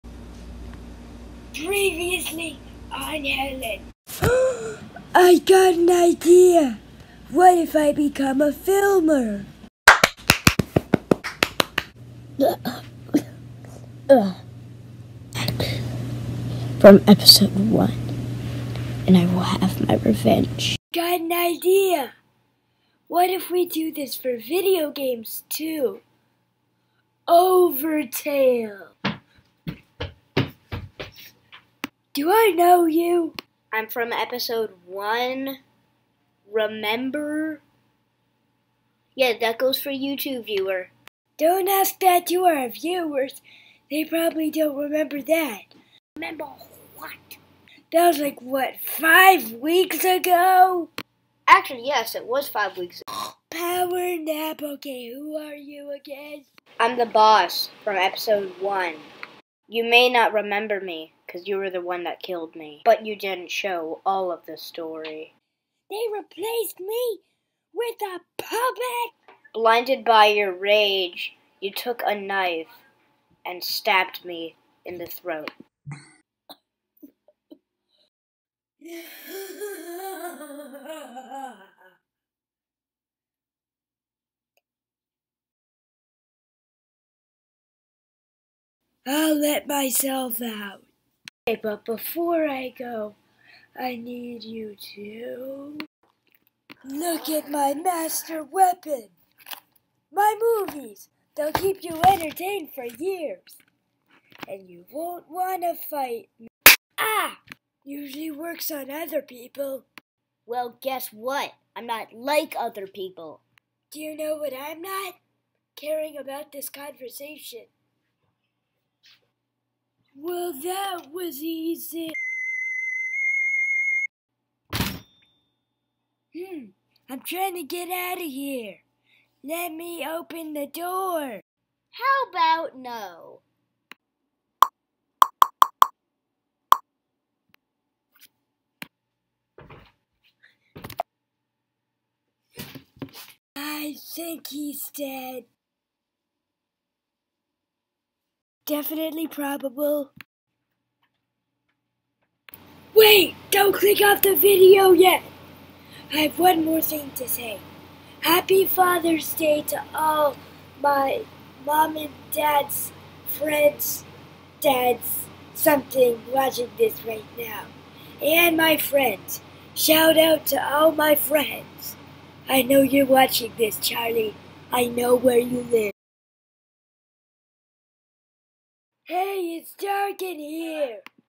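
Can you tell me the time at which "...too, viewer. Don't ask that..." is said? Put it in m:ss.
0:40.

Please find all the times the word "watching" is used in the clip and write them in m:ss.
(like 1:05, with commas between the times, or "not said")
2:46, 2:53.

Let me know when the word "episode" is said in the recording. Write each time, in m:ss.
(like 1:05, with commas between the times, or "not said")
0:17, 0:34, 0:57.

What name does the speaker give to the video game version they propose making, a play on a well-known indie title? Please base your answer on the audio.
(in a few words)
Overtale.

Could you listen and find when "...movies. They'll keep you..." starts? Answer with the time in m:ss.
1:40.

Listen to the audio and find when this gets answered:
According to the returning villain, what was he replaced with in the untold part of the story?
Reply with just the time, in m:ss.
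1:08.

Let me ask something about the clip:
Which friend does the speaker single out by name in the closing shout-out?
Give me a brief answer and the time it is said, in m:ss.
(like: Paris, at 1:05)
Charlie, at 2:53.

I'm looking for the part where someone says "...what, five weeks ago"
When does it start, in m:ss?
0:48.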